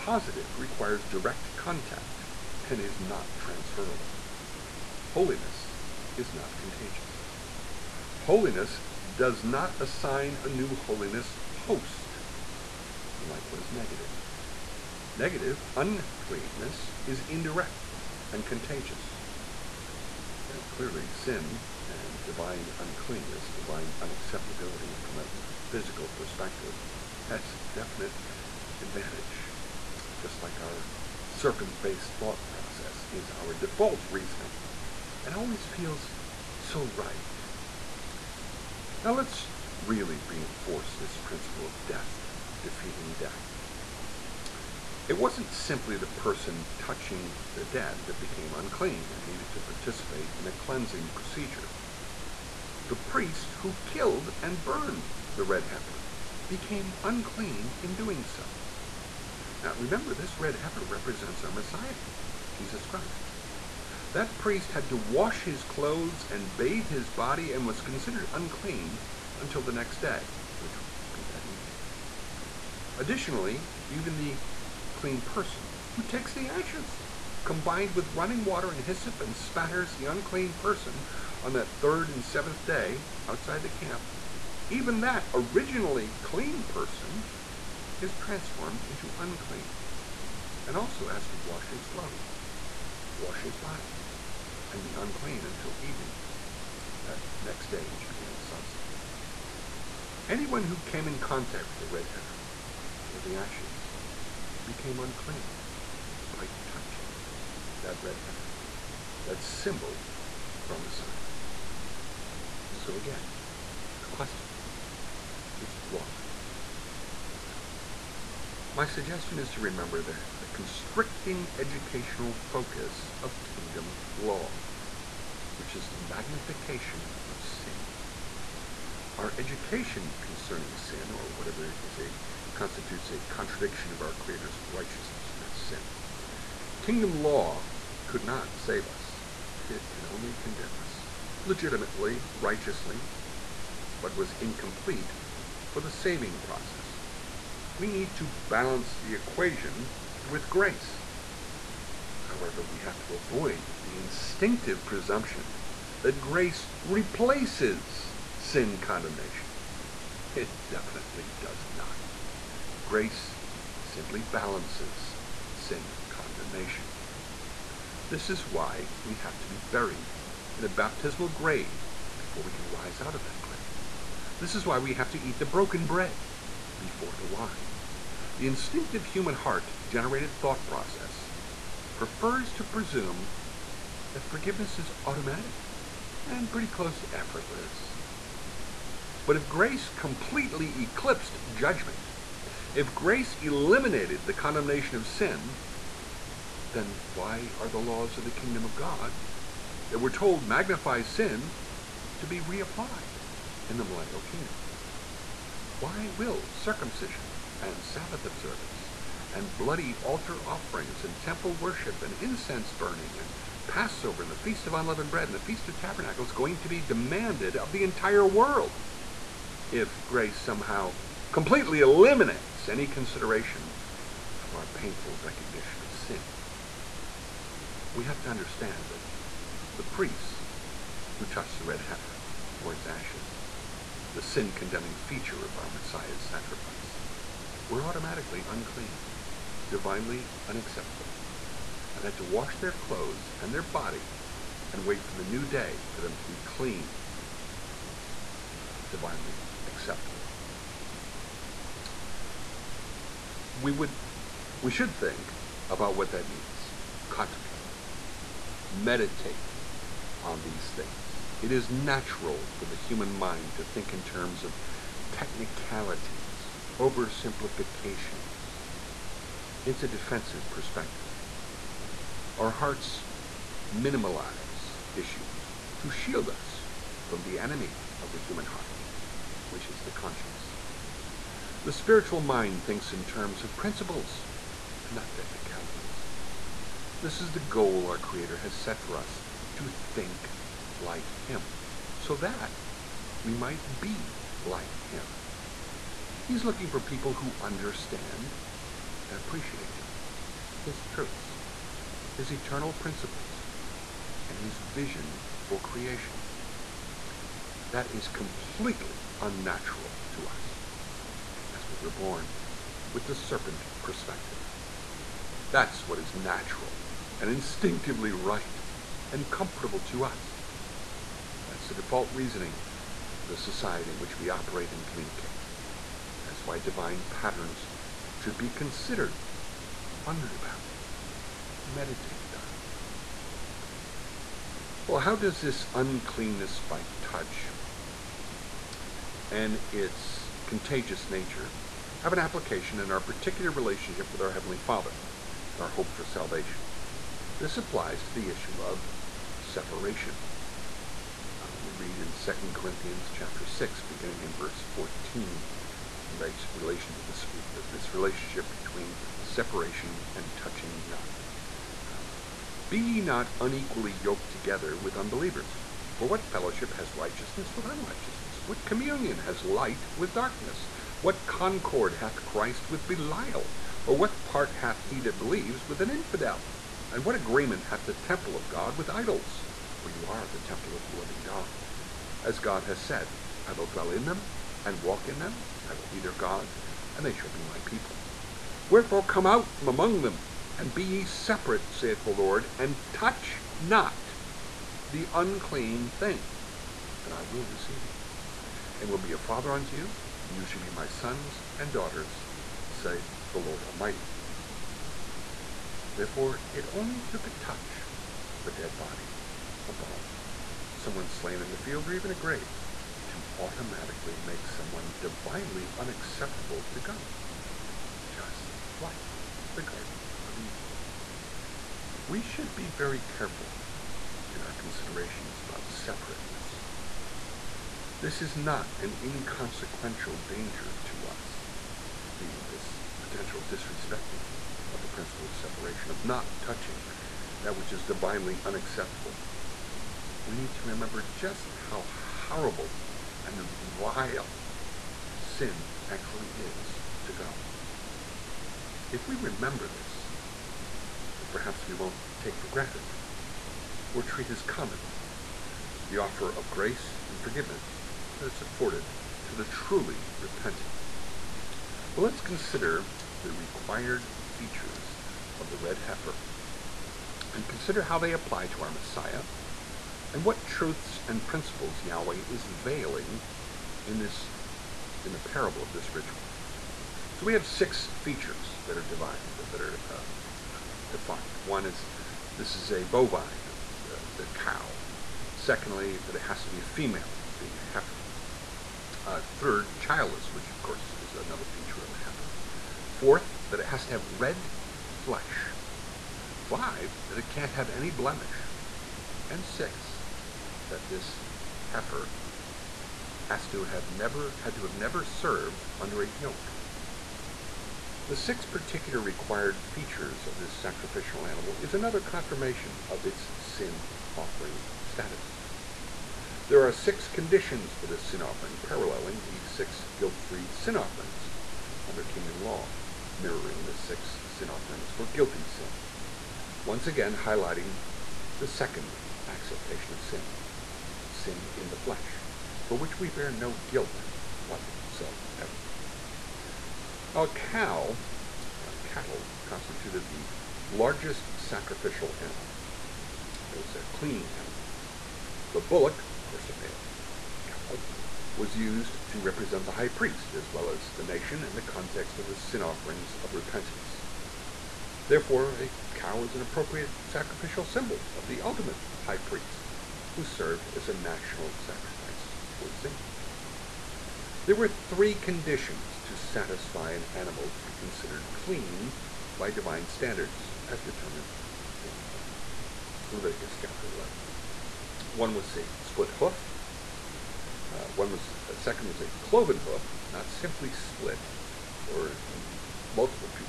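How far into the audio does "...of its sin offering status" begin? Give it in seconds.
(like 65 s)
512 s.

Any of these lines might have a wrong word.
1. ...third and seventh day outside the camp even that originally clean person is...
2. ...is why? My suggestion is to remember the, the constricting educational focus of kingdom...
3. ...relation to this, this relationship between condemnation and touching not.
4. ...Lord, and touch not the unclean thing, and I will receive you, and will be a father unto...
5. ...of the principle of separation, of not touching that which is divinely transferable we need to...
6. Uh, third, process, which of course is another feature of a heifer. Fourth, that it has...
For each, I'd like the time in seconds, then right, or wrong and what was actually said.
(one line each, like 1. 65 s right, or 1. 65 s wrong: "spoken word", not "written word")
1. 81 s right
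2. 115 s right
3. 356 s wrong: "separation", not "condemnation"
4. 392 s right
5. 434 s wrong: "unacceptable", not "transferable"
6. 489 s wrong: "childless", not "process".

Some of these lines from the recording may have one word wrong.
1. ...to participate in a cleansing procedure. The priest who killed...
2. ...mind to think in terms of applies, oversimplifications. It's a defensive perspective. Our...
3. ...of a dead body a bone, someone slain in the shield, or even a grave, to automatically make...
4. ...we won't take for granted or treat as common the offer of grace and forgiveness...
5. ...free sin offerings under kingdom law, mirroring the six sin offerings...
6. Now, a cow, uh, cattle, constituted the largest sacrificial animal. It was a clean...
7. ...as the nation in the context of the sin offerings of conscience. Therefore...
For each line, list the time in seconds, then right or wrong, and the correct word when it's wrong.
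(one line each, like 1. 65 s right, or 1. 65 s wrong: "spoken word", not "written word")
1. 49 s right
2. 263 s wrong: "technicalities", not "applies"
3. 408 s wrong: "field", not "shield"
4. 451 s right
5. 520 s right
6. 537 s right
7. 550 s wrong: "repentance", not "conscience".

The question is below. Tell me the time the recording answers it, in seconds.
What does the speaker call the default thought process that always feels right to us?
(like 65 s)
31 s.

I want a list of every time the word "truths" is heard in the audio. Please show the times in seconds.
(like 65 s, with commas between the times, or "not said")
300 s, 470 s.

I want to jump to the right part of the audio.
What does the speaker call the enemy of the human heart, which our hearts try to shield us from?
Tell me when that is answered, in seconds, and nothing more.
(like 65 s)
279 s.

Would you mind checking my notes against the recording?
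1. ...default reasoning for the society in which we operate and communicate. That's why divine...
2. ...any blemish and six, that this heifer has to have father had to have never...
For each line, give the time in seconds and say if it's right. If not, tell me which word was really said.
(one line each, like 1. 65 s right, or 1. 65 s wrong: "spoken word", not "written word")
1. 321 s right
2. 497 s wrong: "never", not "father".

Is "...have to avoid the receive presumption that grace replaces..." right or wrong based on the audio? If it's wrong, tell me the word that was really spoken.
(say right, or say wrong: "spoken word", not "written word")
wrong: "instinctive", not "receive".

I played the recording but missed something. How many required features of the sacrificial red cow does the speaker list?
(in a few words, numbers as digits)
6.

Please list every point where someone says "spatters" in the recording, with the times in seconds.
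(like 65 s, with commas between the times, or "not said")
79 s.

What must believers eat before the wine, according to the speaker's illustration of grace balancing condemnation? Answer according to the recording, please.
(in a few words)
Broken bread.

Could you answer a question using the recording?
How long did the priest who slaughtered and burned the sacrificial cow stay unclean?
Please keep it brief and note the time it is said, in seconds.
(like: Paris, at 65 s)
The next day, at 69 s.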